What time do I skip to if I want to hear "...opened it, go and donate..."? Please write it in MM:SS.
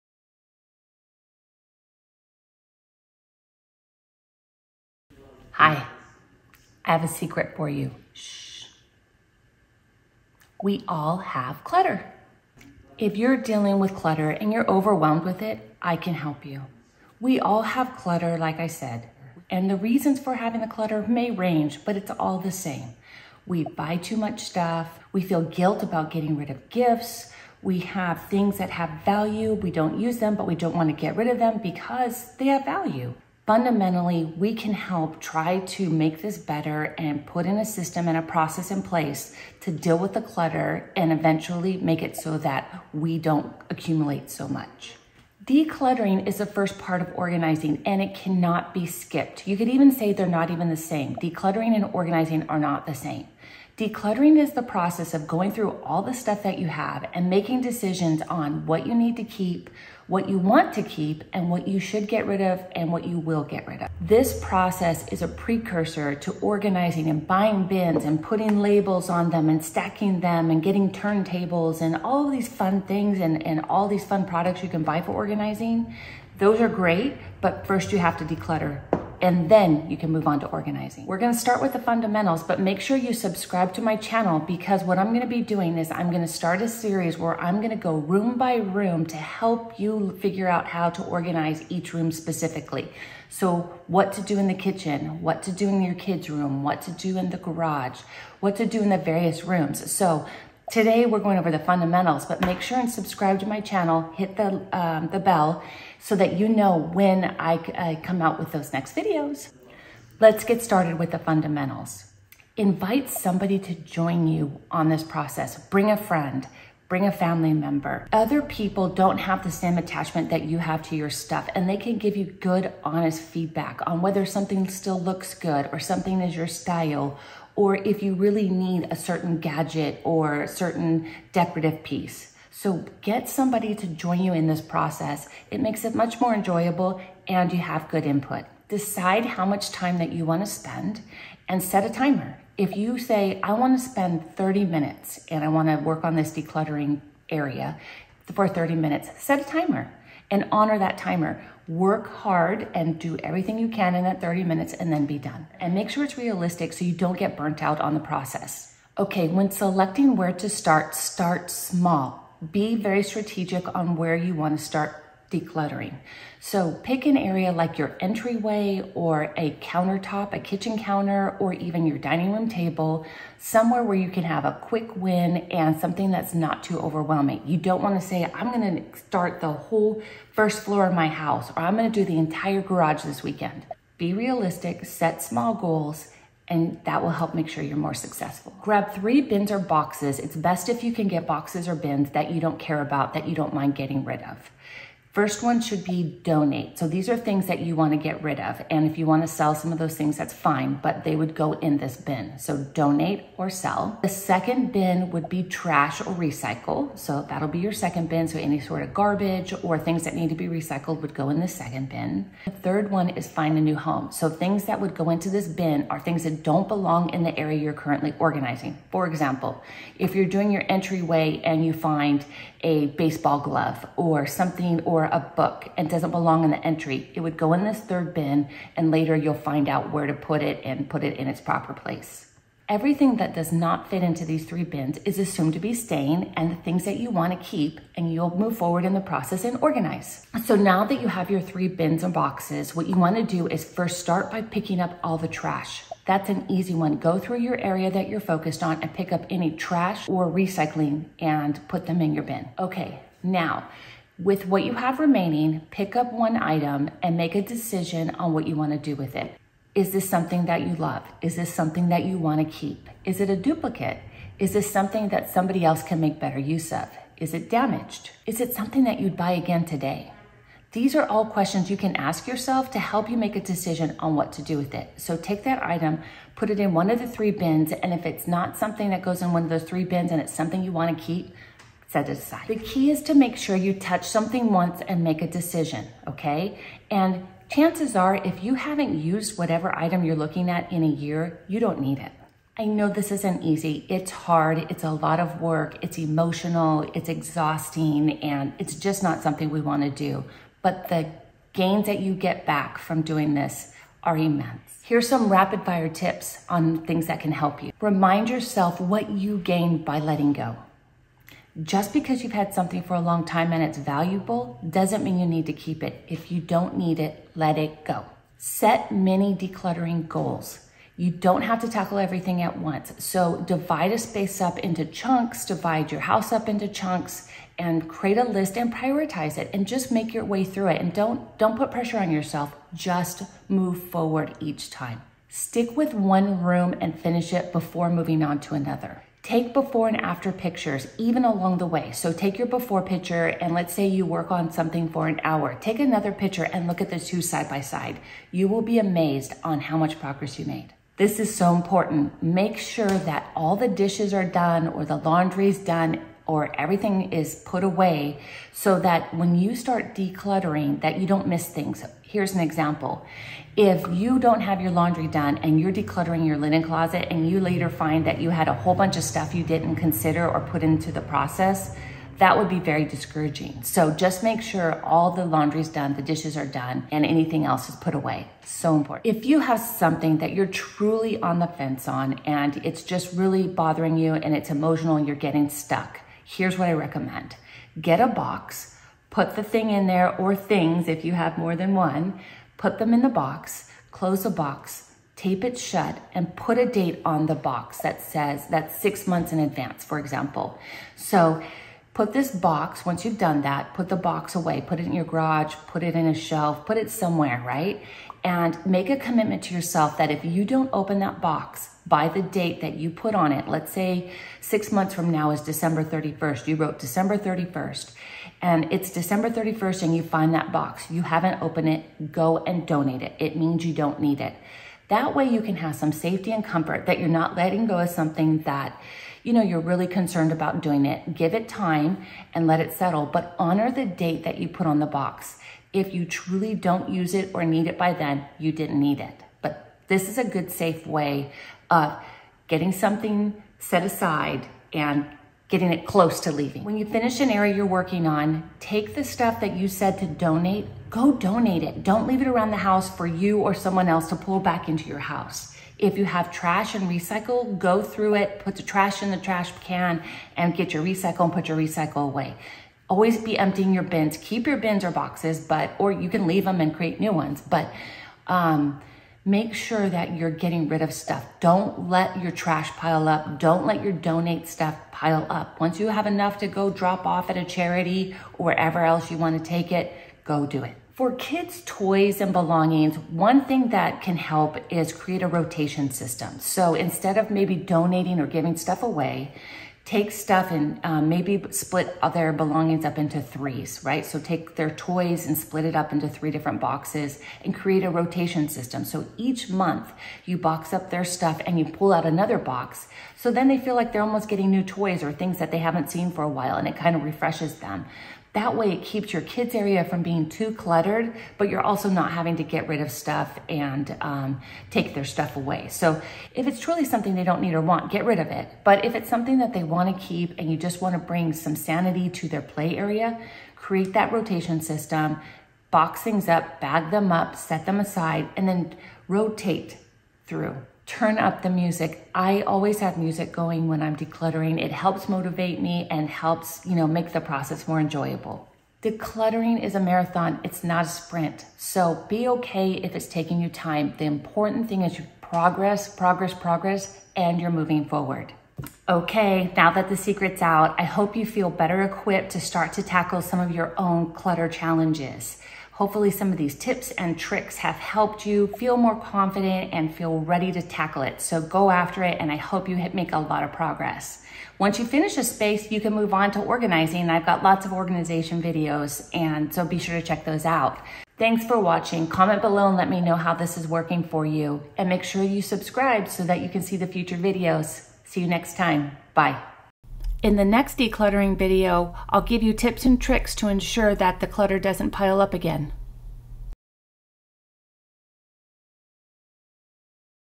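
07:01.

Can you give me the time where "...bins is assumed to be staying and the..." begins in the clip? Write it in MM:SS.
03:54.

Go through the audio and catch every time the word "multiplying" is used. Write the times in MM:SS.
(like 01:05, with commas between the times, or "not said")
not said.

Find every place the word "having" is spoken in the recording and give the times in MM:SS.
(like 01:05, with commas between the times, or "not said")
00:20, 08:32.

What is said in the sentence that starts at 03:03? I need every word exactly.
Be realistic, set small goals, and that will help make sure you're more successful.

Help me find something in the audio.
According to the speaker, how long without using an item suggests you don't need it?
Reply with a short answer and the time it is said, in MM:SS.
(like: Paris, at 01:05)
a year, at 04:50.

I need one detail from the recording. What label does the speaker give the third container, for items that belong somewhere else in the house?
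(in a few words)
find a new home.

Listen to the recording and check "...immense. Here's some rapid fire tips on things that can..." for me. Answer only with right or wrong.
right.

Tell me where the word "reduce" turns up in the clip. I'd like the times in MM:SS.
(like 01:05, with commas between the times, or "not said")
not said.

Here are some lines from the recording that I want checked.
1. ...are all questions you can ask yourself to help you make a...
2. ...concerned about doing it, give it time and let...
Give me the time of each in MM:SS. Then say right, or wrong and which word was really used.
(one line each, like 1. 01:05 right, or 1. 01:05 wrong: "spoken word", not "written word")
1. 04:30 right
2. 07:09 right.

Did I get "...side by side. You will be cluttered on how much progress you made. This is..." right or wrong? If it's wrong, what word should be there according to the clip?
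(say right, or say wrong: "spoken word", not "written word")
wrong: "amazed", not "cluttered".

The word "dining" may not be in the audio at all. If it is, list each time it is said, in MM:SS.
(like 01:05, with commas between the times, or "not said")
02:51.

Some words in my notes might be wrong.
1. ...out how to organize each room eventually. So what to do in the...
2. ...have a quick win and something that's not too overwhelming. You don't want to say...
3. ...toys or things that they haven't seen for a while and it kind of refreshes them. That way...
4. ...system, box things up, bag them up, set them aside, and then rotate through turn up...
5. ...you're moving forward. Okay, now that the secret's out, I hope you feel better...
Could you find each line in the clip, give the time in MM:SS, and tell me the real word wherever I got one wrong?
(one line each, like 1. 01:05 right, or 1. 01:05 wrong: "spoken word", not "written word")
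1. 01:30 wrong: "specifically", not "eventually"
2. 02:54 right
3. 08:24 right
4. 08:44 right
5. 09:07 right.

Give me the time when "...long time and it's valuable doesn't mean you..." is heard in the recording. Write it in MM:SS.
05:13.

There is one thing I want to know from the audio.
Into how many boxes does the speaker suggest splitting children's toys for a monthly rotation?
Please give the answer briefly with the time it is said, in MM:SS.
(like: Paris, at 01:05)
3, at 08:13.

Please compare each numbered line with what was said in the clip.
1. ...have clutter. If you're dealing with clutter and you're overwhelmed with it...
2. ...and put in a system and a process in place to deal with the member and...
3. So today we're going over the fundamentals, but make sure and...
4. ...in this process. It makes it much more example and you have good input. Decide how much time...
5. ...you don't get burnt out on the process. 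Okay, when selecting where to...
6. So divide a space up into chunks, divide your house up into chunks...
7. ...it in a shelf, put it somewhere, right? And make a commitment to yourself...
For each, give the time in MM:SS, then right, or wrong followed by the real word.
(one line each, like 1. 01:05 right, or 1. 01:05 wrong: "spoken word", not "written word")
1. 00:11 right
2. 00:36 wrong: "clutter", not "member"
3. 01:39 right
4. 02:14 wrong: "enjoyable", not "example"
5. 02:36 right
6. 05:22 right
7. 06:45 right.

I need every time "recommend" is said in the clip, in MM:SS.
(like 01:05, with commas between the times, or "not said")
06:26.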